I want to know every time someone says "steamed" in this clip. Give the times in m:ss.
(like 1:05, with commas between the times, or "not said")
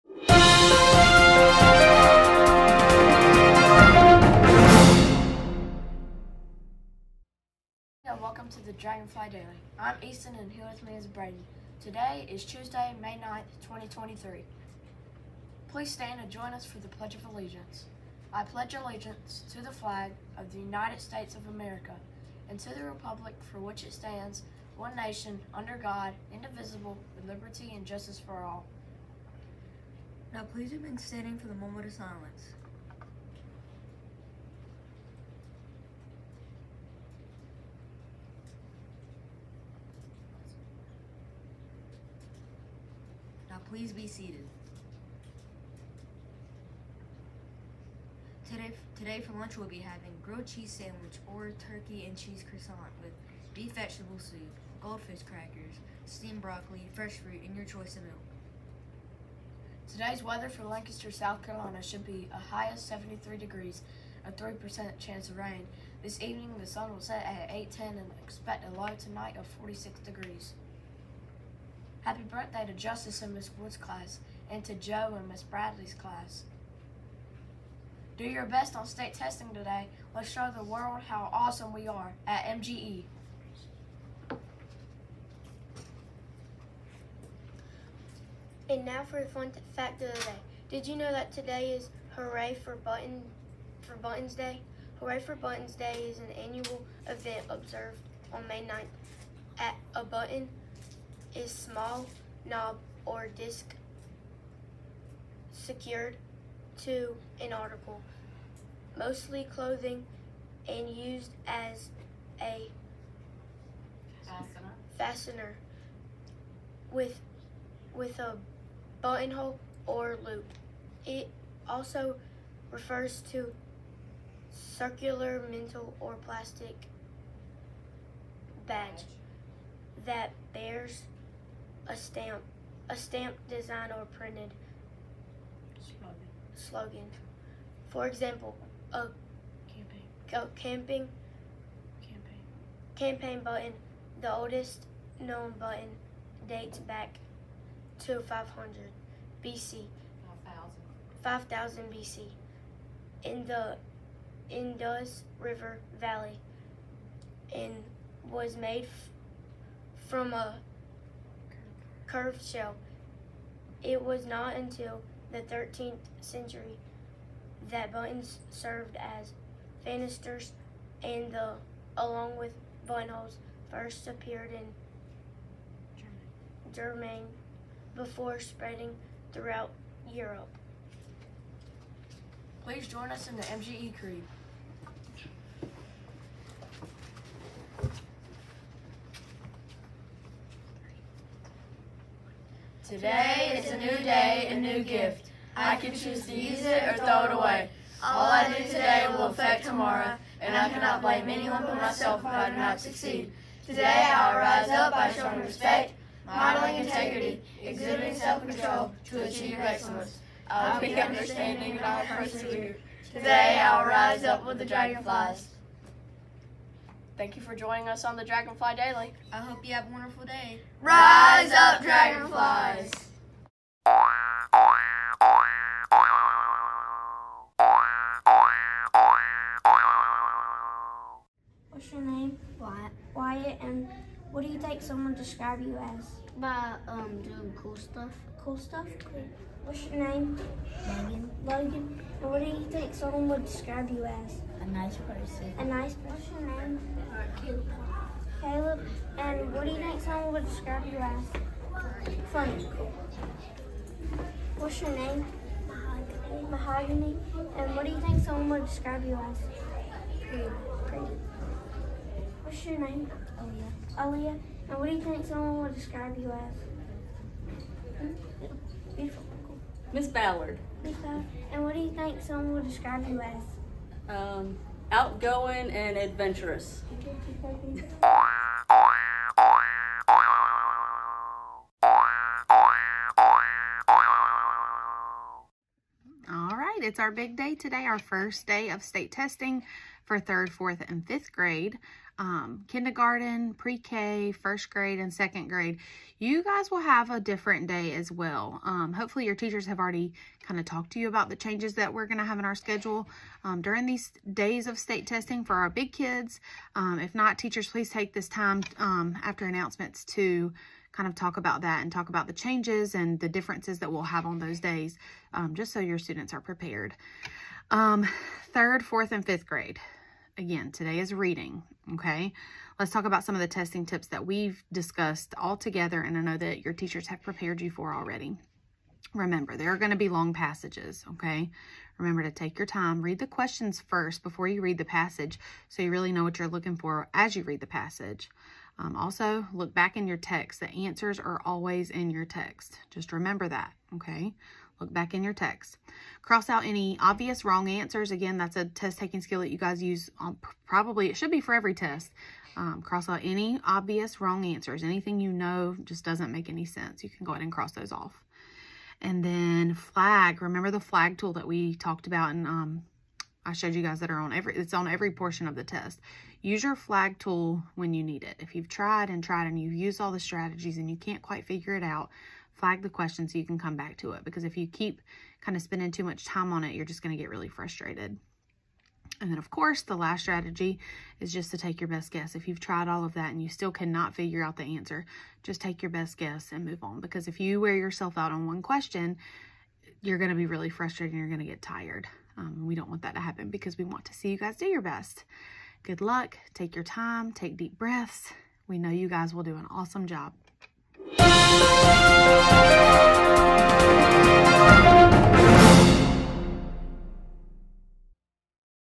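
0:56.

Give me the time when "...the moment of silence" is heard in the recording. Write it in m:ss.
0:31.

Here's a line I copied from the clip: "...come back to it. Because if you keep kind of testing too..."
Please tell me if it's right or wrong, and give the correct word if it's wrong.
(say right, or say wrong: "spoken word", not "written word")
wrong: "spending", not "testing".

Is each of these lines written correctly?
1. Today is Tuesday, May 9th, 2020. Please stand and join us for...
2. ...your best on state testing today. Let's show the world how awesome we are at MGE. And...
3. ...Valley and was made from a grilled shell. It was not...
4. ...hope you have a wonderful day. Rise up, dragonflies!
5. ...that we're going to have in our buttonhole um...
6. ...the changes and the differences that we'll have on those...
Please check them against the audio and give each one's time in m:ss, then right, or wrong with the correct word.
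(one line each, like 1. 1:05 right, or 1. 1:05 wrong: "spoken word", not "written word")
1. 0:11 wrong: "2023", not "2020"
2. 1:18 right
3. 2:35 wrong: "curved", not "grilled"
4. 3:39 right
5. 5:01 wrong: "schedule", not "buttonhole"
6. 5:12 right.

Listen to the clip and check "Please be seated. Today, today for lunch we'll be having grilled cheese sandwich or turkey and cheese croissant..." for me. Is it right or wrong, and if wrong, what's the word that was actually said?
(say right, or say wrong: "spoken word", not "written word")
right.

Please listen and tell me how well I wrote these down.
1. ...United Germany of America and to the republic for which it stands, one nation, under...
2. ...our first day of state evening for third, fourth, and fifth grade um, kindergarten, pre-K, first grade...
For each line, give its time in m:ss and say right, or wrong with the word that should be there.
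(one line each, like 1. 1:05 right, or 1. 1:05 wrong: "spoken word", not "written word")
1. 0:20 wrong: "States", not "Germany"
2. 4:47 wrong: "testing", not "evening".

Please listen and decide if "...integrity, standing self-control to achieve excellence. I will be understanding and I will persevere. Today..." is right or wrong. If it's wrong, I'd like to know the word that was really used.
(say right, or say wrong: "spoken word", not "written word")
wrong: "exhibiting", not "standing".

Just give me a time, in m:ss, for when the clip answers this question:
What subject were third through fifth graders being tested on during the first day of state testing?
5:21.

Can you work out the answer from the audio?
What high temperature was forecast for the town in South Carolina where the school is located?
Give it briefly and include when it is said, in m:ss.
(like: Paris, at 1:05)
73 degrees, at 1:02.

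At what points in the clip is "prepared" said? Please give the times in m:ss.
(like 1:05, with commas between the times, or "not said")
5:16, 5:27.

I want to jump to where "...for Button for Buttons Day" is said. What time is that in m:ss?
1:32.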